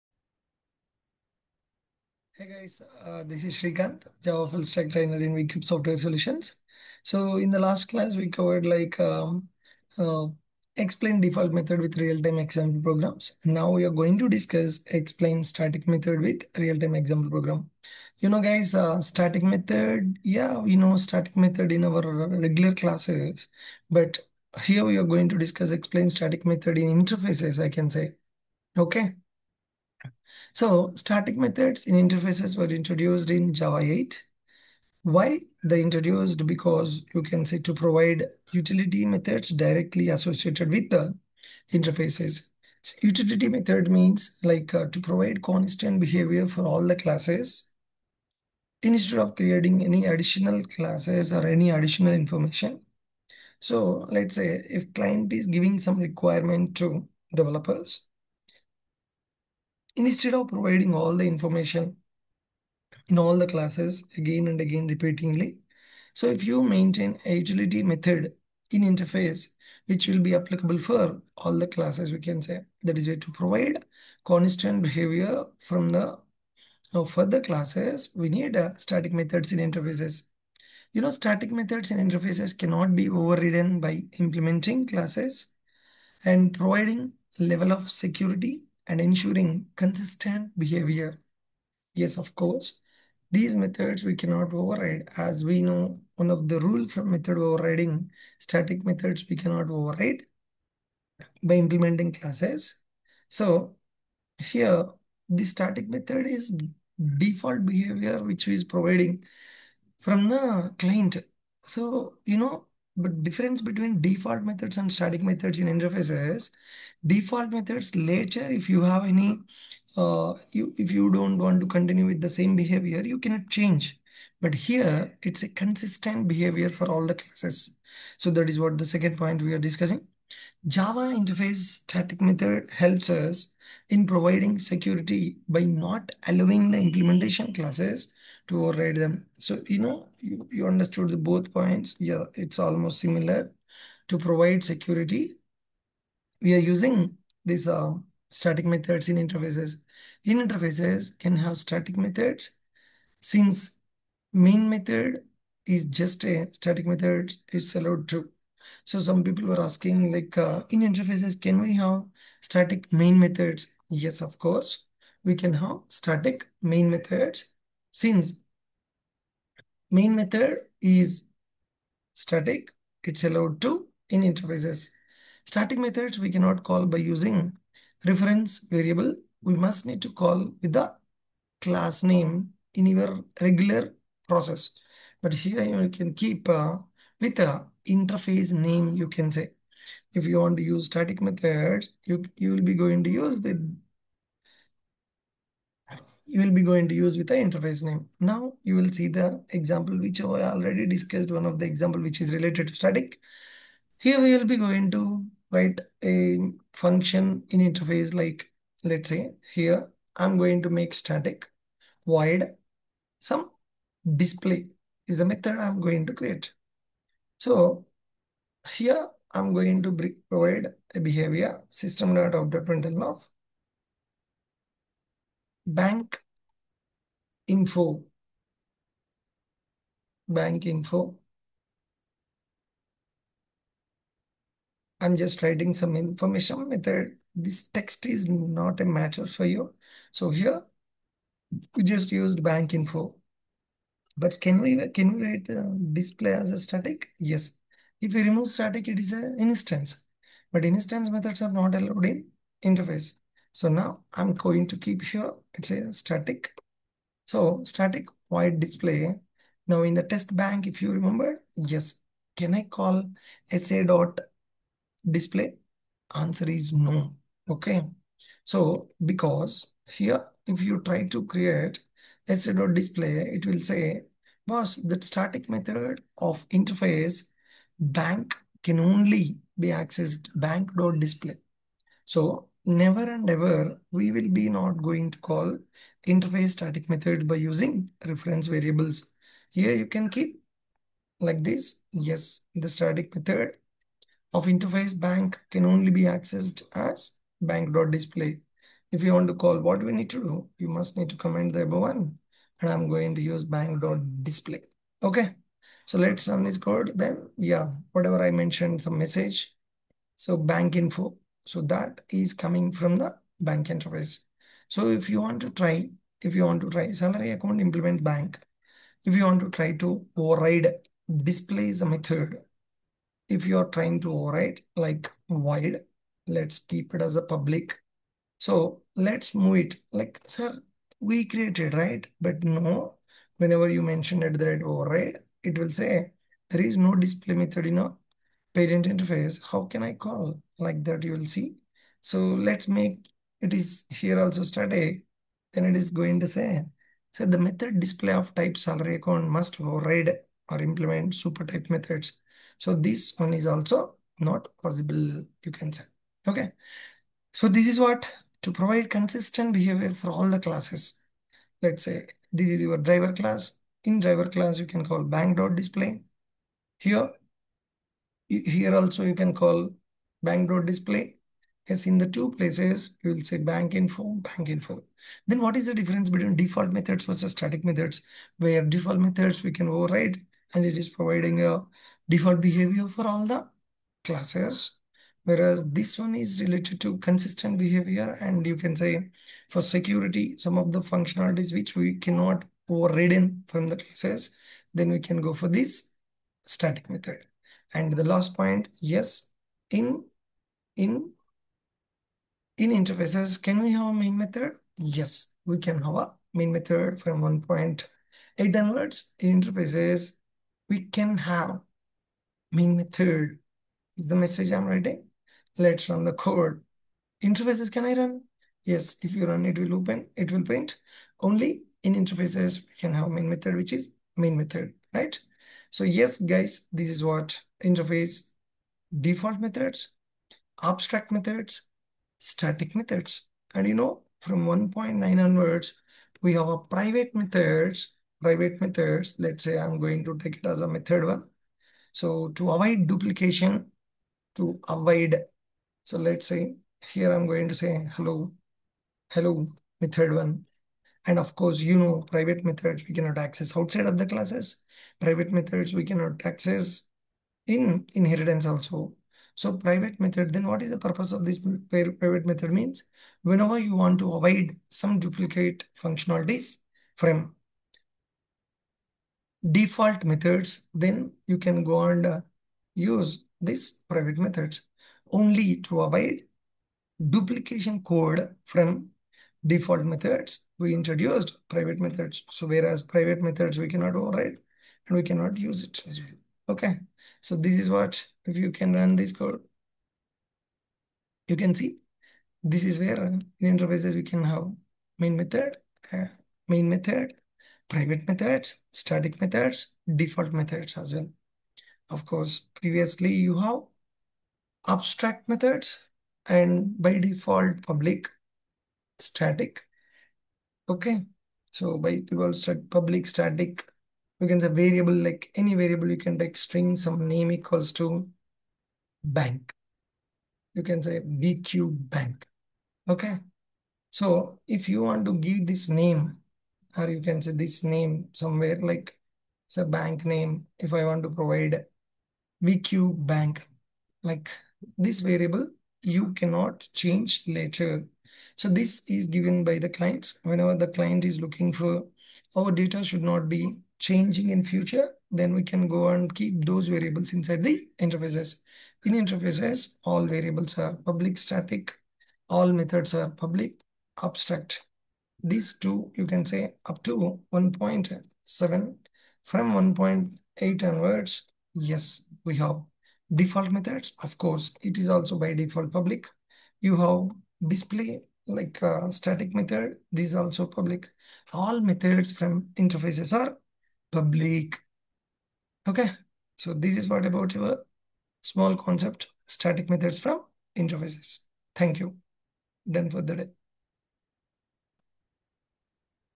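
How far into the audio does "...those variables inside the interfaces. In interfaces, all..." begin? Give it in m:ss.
9:06.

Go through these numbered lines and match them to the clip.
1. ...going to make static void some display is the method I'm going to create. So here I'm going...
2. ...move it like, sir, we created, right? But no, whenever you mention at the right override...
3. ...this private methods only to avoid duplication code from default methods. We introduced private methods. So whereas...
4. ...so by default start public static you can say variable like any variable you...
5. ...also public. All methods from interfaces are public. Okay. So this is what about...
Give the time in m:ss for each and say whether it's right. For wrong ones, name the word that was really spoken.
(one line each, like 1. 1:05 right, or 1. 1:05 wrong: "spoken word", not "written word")
1. 3:30 right
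2. 5:29 right
3. 7:53 right
4. 8:31 right
5. 9:30 right.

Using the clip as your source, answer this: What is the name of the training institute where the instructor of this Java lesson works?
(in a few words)
VCube Software Solutions.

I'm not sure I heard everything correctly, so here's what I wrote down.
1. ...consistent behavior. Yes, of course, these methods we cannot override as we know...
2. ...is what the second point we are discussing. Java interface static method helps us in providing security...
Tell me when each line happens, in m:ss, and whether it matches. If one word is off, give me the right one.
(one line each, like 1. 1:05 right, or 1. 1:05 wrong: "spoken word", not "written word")
1. 1:29 right
2. 2:08 right.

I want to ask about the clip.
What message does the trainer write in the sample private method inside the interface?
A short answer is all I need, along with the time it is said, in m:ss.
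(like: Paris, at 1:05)
hello method one, at 7:29.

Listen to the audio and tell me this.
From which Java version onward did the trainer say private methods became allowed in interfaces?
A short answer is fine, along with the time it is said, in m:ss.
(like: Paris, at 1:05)
1.9, at 7:14.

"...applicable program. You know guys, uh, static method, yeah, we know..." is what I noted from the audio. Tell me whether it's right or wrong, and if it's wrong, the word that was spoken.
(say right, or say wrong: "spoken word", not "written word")
wrong: "example", not "applicable".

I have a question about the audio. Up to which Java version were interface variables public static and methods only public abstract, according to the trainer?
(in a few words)
1.7.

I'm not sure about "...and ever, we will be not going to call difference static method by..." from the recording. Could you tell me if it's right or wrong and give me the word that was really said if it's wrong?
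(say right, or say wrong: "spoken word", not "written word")
wrong: "interface", not "difference".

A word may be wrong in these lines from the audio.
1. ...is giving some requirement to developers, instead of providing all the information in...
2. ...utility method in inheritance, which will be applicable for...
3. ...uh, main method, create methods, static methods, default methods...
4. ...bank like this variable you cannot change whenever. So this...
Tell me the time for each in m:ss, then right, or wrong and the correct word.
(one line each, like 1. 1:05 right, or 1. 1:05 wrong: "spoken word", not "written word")
1. 0:55 right
2. 1:07 wrong: "interface", not "inheritance"
3. 8:15 wrong: "private", not "create"
4. 8:53 wrong: "later", not "whenever".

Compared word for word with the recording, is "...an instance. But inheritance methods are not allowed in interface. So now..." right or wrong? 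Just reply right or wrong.
wrong.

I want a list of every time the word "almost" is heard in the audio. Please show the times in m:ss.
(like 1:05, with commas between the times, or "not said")
2:22.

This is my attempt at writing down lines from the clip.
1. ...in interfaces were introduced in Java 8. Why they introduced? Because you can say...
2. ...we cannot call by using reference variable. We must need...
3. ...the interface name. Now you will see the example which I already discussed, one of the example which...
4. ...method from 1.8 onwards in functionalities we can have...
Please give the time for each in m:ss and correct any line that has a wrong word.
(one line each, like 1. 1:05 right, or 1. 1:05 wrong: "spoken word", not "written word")
1. 0:31 right
2. 2:56 right
3. 3:17 right
4. 6:46 wrong: "interfaces", not "functionalities".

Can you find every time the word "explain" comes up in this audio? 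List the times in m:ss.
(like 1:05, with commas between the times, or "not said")
0:10, 0:14, 0:25.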